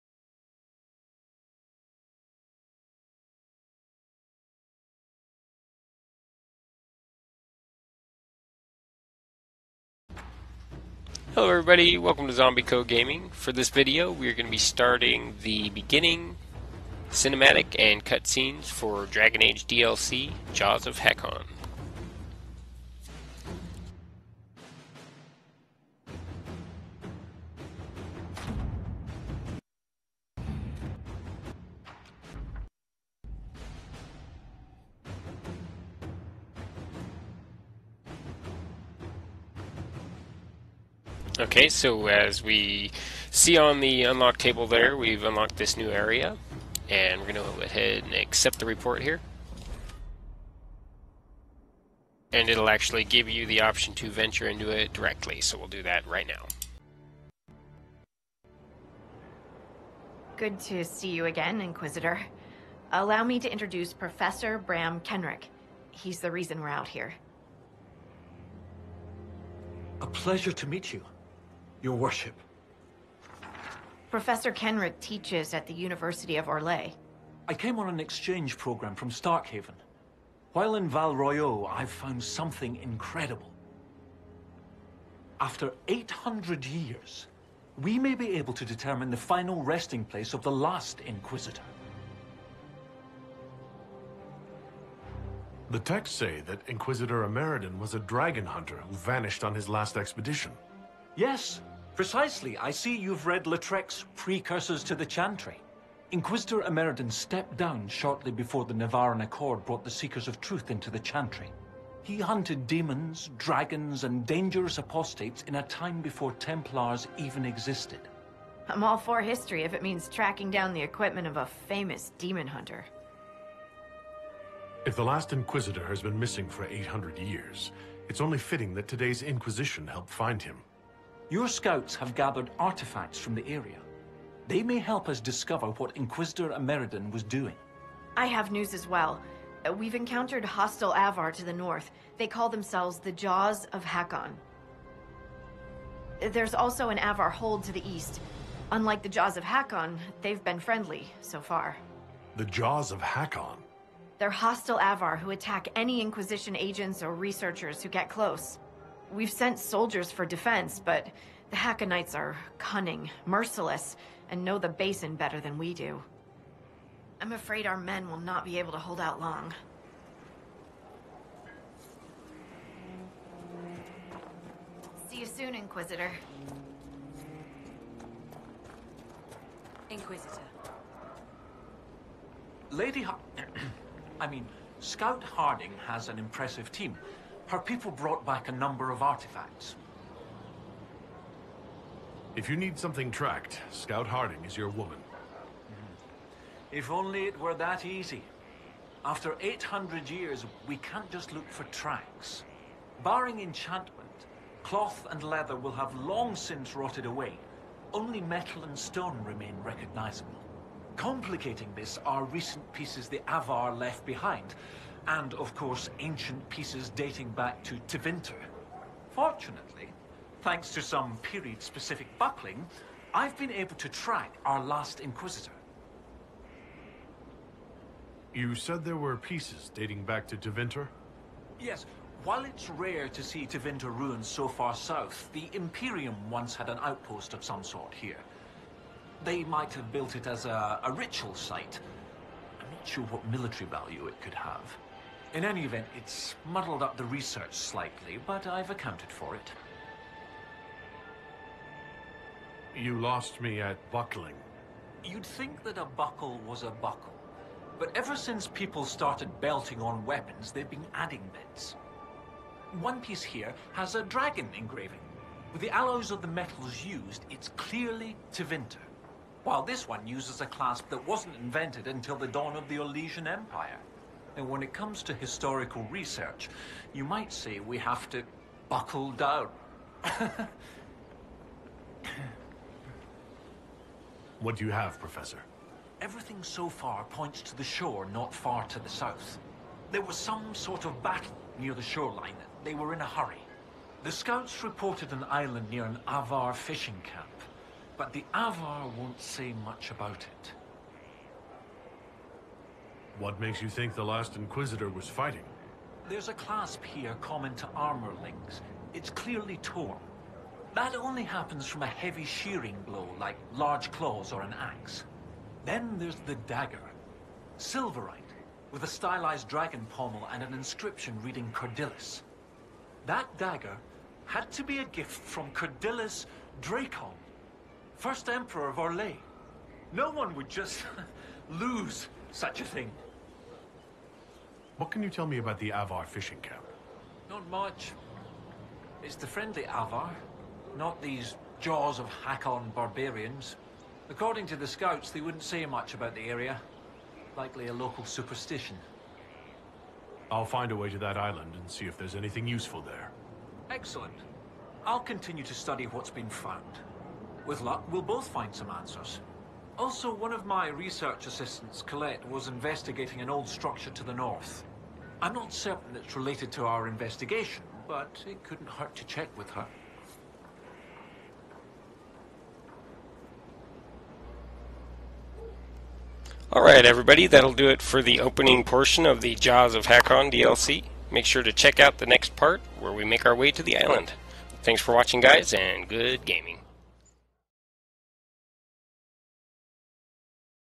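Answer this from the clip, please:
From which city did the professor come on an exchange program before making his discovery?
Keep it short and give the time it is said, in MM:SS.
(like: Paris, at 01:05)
Starkhaven, at 01:19.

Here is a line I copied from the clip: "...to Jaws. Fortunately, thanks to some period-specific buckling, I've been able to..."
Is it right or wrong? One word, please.
wrong.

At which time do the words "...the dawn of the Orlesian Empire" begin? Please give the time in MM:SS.
04:32.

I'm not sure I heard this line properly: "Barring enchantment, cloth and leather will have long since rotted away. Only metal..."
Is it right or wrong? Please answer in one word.
right.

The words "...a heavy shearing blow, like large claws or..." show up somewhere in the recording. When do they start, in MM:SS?
05:11.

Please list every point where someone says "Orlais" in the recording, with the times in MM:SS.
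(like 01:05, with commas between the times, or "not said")
01:16, 05:28.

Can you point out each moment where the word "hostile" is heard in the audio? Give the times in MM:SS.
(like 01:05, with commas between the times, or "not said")
02:20, 02:34.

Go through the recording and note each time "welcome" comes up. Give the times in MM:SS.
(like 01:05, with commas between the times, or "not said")
00:11.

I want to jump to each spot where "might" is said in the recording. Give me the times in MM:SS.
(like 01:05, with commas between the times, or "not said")
03:59, 04:37.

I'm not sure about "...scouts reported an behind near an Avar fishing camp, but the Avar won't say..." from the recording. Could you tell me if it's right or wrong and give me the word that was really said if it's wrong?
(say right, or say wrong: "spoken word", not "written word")
wrong: "island", not "behind".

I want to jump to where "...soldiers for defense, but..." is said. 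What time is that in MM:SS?
02:39.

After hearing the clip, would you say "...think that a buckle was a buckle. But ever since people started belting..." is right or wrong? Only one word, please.
right.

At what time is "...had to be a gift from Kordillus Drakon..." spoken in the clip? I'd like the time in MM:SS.
05:24.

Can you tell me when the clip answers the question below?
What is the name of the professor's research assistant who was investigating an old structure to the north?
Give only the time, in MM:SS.
06:01.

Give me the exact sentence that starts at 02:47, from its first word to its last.
I'm afraid our men will not be able to hold out long.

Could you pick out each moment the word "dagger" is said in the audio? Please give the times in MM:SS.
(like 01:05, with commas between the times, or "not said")
05:16, 05:23.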